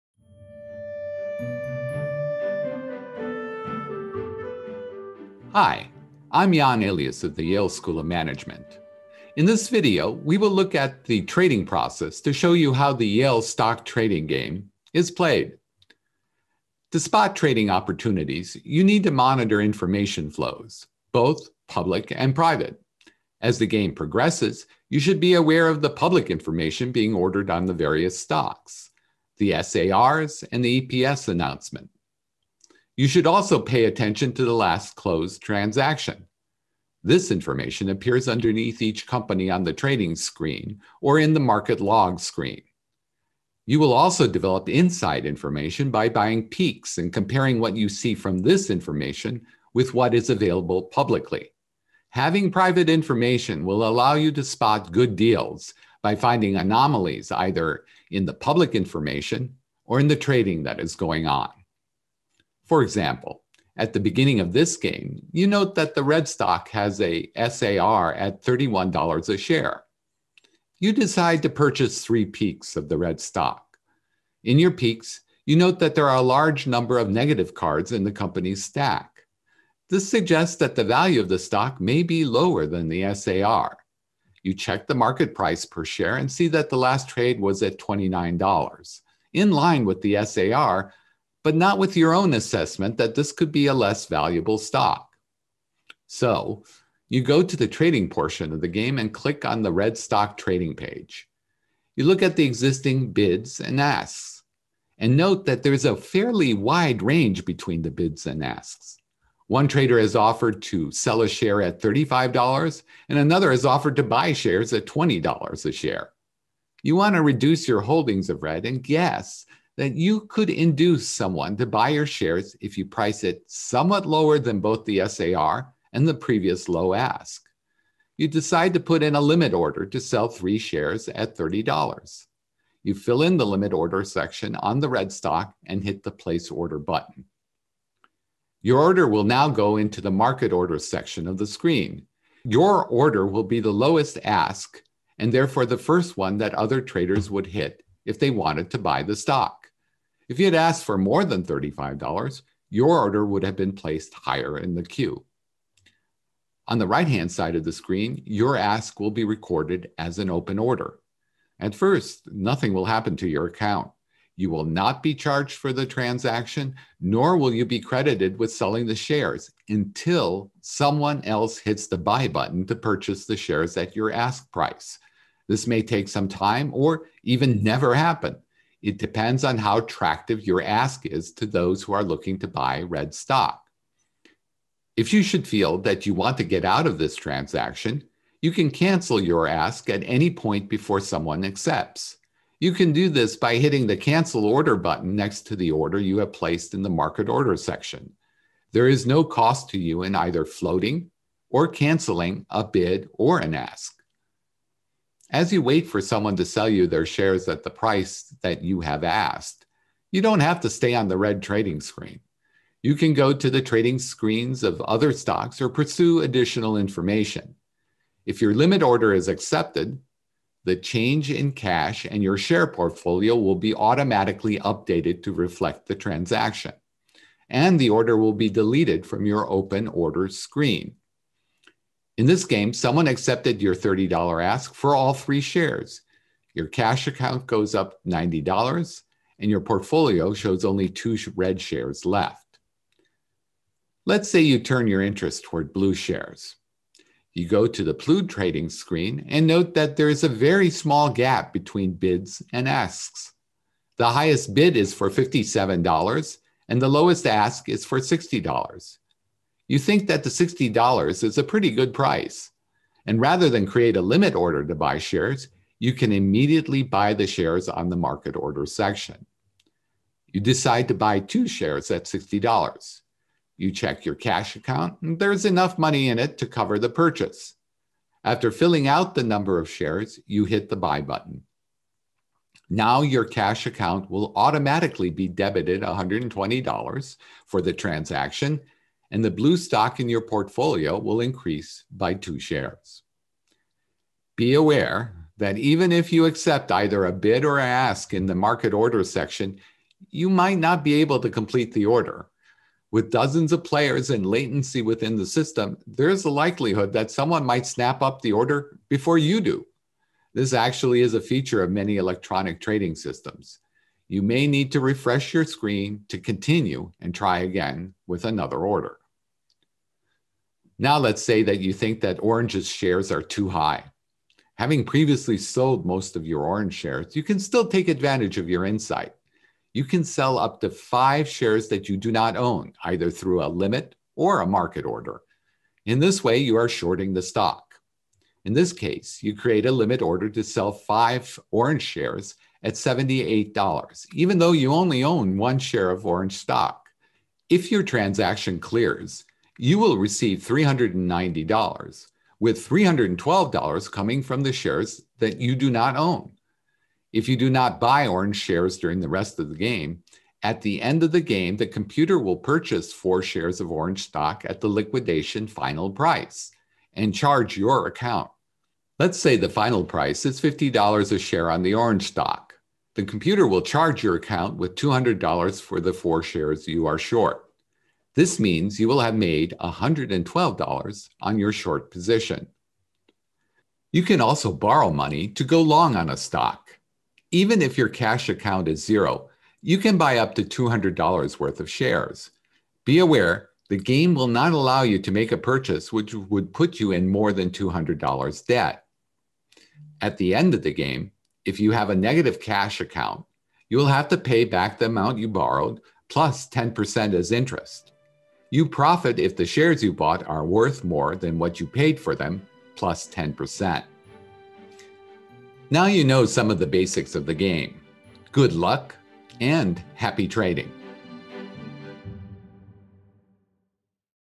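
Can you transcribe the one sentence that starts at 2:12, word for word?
You fill in the limit order section on the red stock and hit the place order button.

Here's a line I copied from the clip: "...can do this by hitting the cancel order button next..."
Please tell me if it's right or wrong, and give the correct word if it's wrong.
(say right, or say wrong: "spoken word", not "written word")
right.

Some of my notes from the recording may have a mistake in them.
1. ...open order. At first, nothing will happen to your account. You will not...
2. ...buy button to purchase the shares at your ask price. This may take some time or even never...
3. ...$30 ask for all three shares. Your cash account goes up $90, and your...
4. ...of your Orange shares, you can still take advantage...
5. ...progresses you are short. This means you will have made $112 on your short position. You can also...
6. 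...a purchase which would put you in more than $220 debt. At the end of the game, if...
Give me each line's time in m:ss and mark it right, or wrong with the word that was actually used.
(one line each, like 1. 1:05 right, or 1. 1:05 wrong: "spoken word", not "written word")
1. 2:40 right
2. 2:51 right
3. 3:53 right
4. 5:26 right
5. 6:16 wrong: "shares", not "progresses"
6. 6:35 wrong: "200", not "220".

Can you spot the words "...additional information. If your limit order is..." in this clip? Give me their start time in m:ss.
3:36.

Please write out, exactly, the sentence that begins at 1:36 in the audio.
So you go to the trading portion of the game and click on the red stock trading page.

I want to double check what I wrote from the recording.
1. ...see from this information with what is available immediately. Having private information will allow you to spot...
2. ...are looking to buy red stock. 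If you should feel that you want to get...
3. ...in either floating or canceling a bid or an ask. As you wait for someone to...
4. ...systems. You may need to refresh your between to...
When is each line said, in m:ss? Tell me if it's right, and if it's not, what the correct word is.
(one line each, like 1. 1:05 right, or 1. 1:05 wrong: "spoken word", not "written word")
1. 0:47 wrong: "publicly", not "immediately"
2. 3:01 right
3. 3:20 right
4. 5:12 wrong: "screen", not "between".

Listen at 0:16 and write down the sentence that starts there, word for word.
To spot trading opportunities, you need to monitor information flows, both public and private.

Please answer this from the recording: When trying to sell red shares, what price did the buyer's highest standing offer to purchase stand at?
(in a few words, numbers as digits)
$20.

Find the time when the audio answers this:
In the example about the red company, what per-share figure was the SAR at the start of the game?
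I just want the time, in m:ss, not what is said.
1:08.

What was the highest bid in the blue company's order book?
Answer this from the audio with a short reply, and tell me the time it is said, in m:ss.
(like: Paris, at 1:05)
$57, at 4:15.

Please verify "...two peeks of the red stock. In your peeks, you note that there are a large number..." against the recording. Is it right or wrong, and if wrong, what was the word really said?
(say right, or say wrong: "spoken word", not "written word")
wrong: "three", not "two".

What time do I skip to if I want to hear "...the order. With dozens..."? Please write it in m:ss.
5:01.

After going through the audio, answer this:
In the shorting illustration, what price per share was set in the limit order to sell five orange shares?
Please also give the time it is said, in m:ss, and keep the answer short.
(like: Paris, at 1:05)
$78, at 5:42.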